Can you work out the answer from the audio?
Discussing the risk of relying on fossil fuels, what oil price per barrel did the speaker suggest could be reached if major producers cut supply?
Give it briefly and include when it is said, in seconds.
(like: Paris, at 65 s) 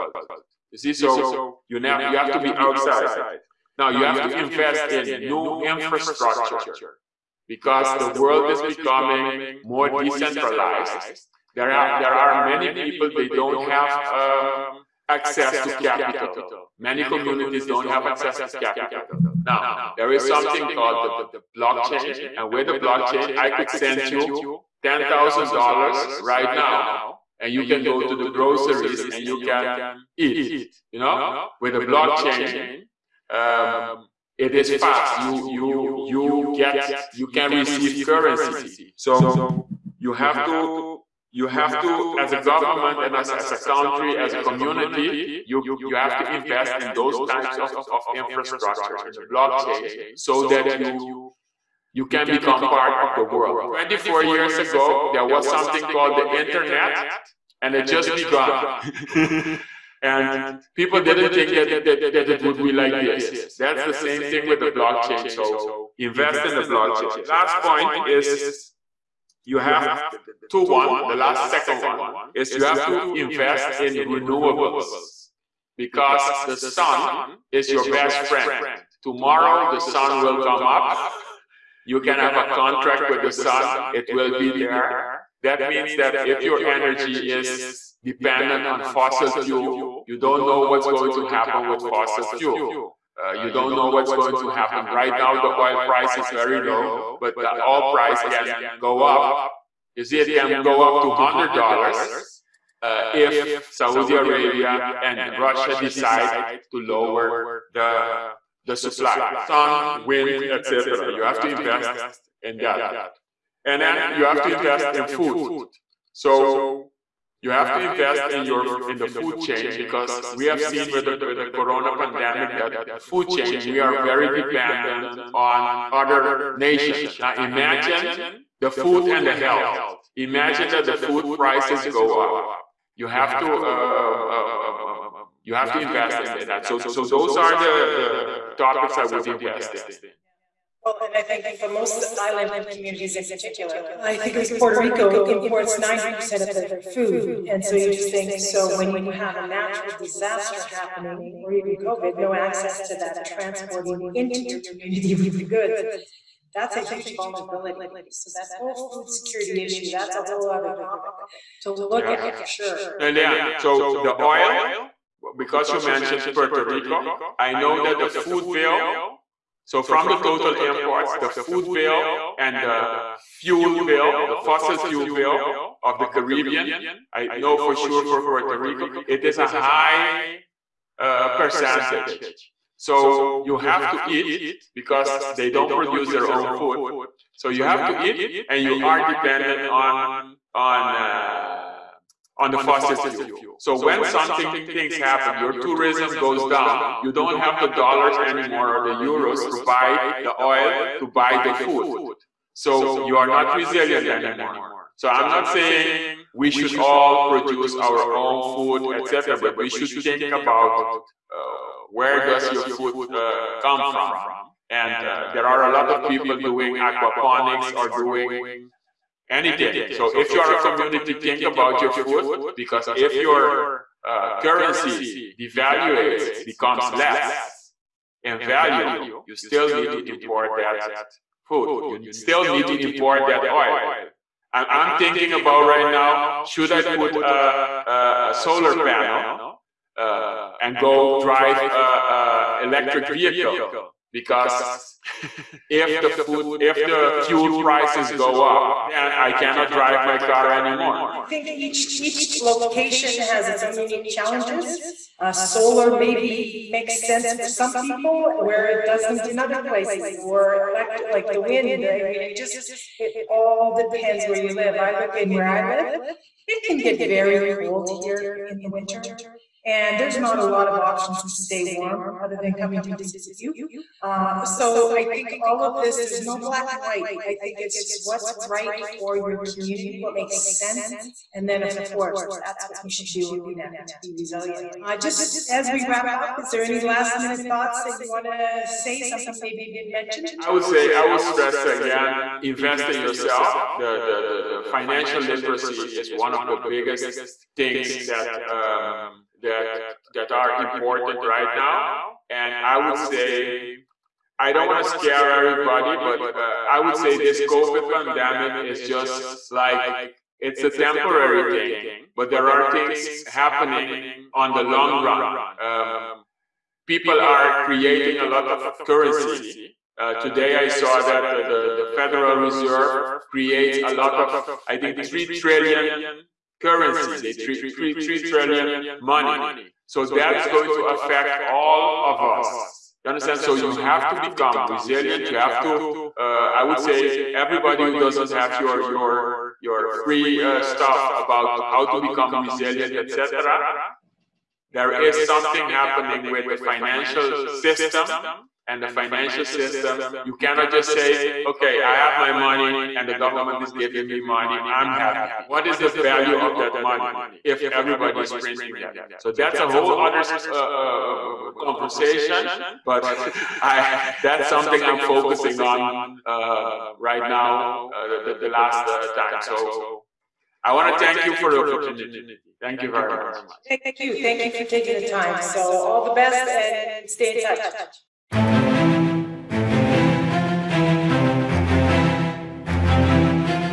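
$100, at 101 s.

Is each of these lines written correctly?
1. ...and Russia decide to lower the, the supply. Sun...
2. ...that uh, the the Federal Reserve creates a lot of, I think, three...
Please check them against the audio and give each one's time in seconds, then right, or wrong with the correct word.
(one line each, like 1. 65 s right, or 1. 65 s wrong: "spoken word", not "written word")
1. 104 s right
2. 321 s right.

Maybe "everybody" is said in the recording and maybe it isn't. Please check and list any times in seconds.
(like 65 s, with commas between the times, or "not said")
305 s, 337 s, 357 s.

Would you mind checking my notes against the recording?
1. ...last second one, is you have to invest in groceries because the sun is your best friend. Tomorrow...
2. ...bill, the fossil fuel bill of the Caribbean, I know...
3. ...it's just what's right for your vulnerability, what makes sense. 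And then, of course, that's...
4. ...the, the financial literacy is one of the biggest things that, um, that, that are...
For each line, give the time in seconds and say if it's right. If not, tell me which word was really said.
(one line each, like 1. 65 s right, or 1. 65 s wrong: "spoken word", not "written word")
1. 71 s wrong: "renewables", not "groceries"
2. 173 s right
3. 277 s wrong: "community", not "vulnerability"
4. 294 s right.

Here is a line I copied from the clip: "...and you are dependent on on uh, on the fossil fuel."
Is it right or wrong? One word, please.
right.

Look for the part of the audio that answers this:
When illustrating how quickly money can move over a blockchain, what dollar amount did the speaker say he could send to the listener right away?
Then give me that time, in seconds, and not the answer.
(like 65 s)
24 s.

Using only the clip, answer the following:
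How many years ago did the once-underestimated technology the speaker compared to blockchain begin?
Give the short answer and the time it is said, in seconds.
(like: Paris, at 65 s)
24, at 53 s.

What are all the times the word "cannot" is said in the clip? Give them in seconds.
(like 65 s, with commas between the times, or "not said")
249 s, 350 s.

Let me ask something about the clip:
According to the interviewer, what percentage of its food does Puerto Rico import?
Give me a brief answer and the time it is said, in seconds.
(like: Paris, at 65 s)
90%, at 145 s.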